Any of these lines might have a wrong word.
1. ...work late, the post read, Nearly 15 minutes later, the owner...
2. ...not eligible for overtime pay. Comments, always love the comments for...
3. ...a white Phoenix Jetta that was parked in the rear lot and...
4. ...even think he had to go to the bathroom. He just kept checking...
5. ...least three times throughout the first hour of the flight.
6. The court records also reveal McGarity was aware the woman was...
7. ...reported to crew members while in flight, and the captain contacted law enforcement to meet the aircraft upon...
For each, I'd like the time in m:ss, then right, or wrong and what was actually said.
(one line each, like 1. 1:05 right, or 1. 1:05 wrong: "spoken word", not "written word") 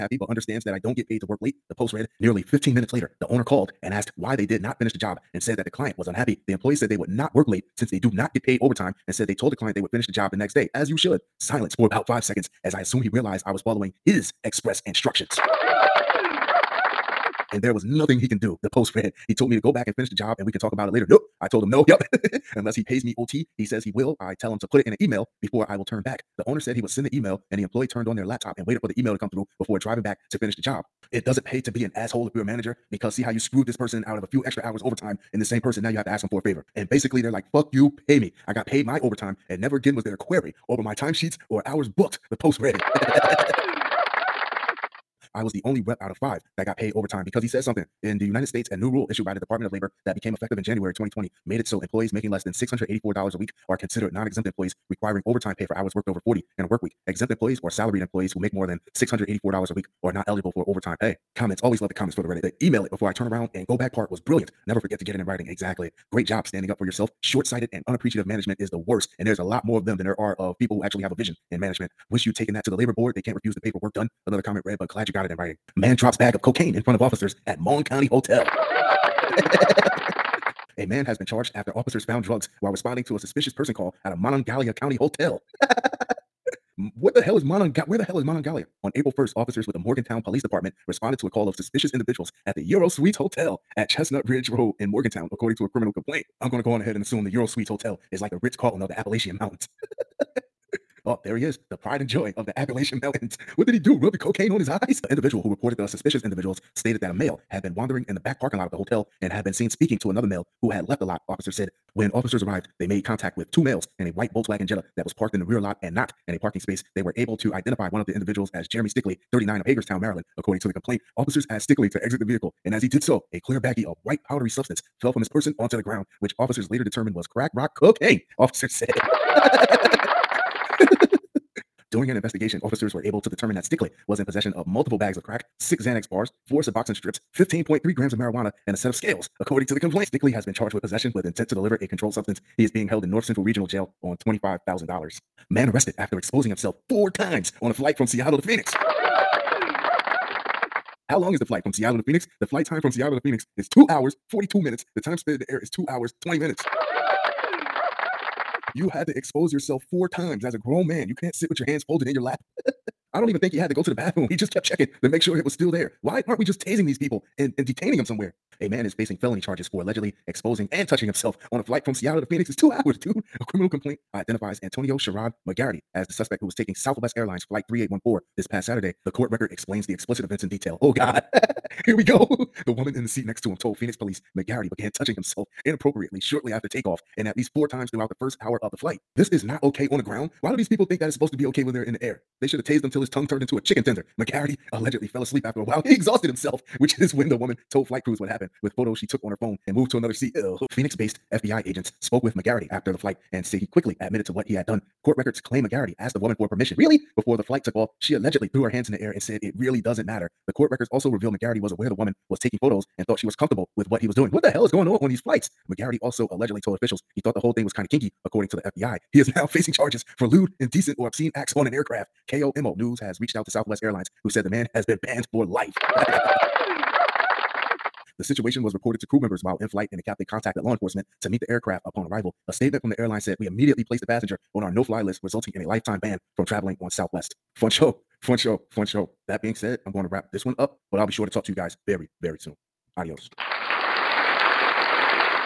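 1. 0:01 right
2. 1:00 right
3. 1:54 wrong: "Volkswagen", not "Phoenix"
4. 2:43 right
5. 3:07 wrong: "four", not "three"
6. 3:30 right
7. 3:48 right.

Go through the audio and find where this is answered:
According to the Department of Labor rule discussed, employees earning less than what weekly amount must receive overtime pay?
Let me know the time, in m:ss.
0:52.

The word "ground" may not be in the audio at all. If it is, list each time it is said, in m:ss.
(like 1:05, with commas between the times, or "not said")
2:05, 3:10.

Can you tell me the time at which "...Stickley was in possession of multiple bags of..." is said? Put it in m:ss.
2:13.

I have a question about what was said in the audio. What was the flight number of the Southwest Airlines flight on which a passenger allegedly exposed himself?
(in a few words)
3814.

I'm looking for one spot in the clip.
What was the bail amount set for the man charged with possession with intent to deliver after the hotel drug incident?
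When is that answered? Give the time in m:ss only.
2:24.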